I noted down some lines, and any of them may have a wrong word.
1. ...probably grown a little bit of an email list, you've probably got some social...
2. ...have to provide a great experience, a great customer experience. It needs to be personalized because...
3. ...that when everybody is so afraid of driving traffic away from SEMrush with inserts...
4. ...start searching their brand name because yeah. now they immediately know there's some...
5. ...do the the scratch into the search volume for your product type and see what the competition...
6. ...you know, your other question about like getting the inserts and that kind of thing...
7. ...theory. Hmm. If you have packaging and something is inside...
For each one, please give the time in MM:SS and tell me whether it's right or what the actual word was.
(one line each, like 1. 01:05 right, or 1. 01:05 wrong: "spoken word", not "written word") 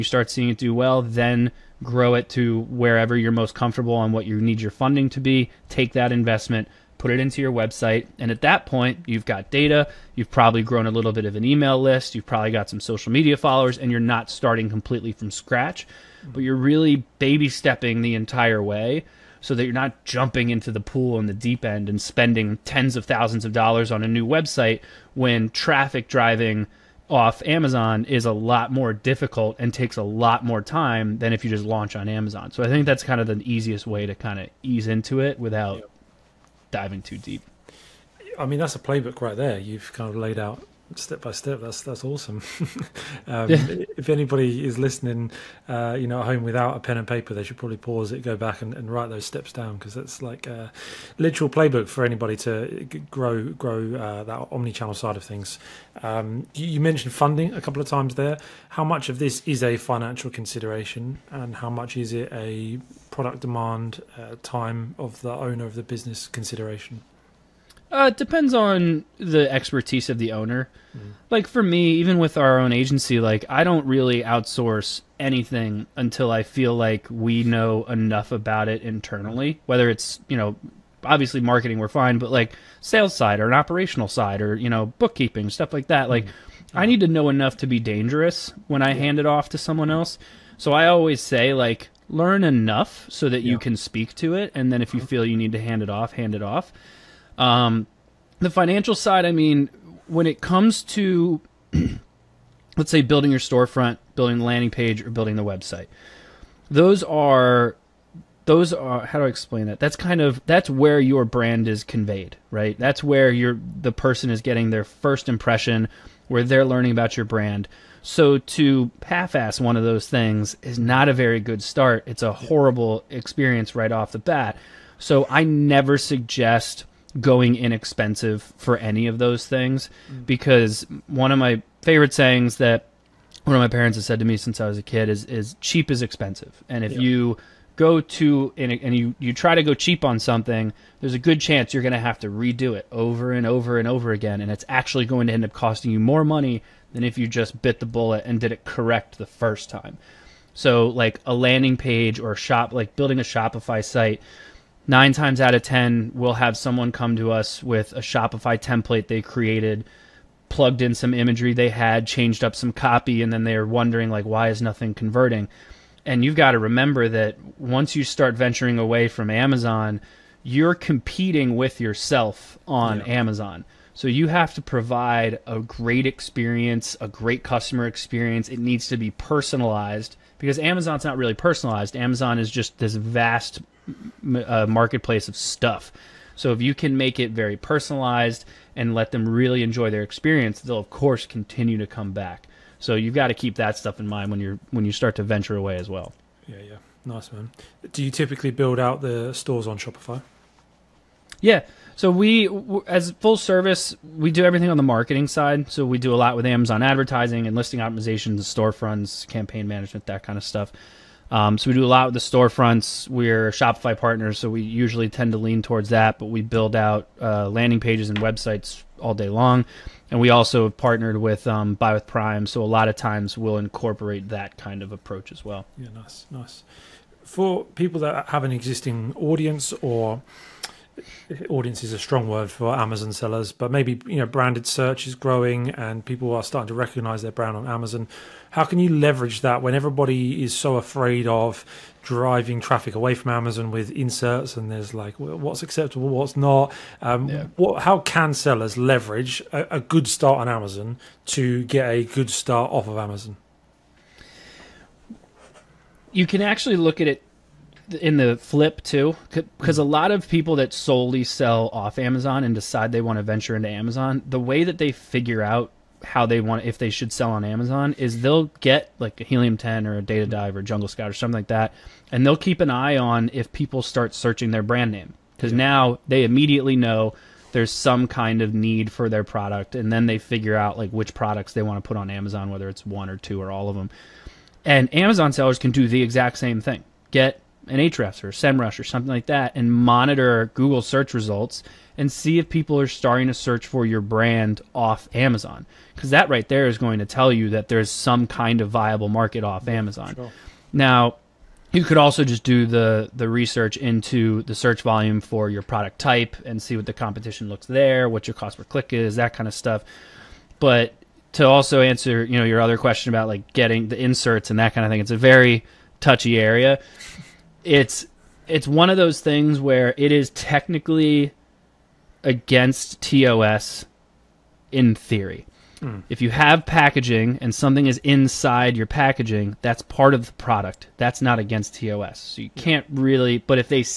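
1. 00:10 right
2. 02:54 right
3. 03:59 wrong: "Amazon", not "SEMrush"
4. 04:33 right
5. 05:02 wrong: "research", not "scratch"
6. 05:12 right
7. 05:24 right.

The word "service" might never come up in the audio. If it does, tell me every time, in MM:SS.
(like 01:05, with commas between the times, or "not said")
03:23.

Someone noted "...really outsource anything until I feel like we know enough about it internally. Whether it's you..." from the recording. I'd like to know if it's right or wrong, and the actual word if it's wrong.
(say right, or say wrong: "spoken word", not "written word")
right.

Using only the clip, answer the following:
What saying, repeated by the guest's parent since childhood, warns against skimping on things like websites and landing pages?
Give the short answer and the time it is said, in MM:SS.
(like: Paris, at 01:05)
Cheap is expensive, at 02:15.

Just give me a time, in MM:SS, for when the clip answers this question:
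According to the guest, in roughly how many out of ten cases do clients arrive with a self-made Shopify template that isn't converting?
02:34.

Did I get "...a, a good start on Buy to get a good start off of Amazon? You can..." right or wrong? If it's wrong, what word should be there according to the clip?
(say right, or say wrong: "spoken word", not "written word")
wrong: "Amazon", not "Buy".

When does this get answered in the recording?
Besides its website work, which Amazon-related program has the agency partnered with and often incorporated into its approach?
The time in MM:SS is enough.
03:41.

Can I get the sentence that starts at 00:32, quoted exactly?
So I think that's kind of the easiest way to kind of ease into it without diving too deep.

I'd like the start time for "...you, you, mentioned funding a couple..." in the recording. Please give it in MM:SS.
00:56.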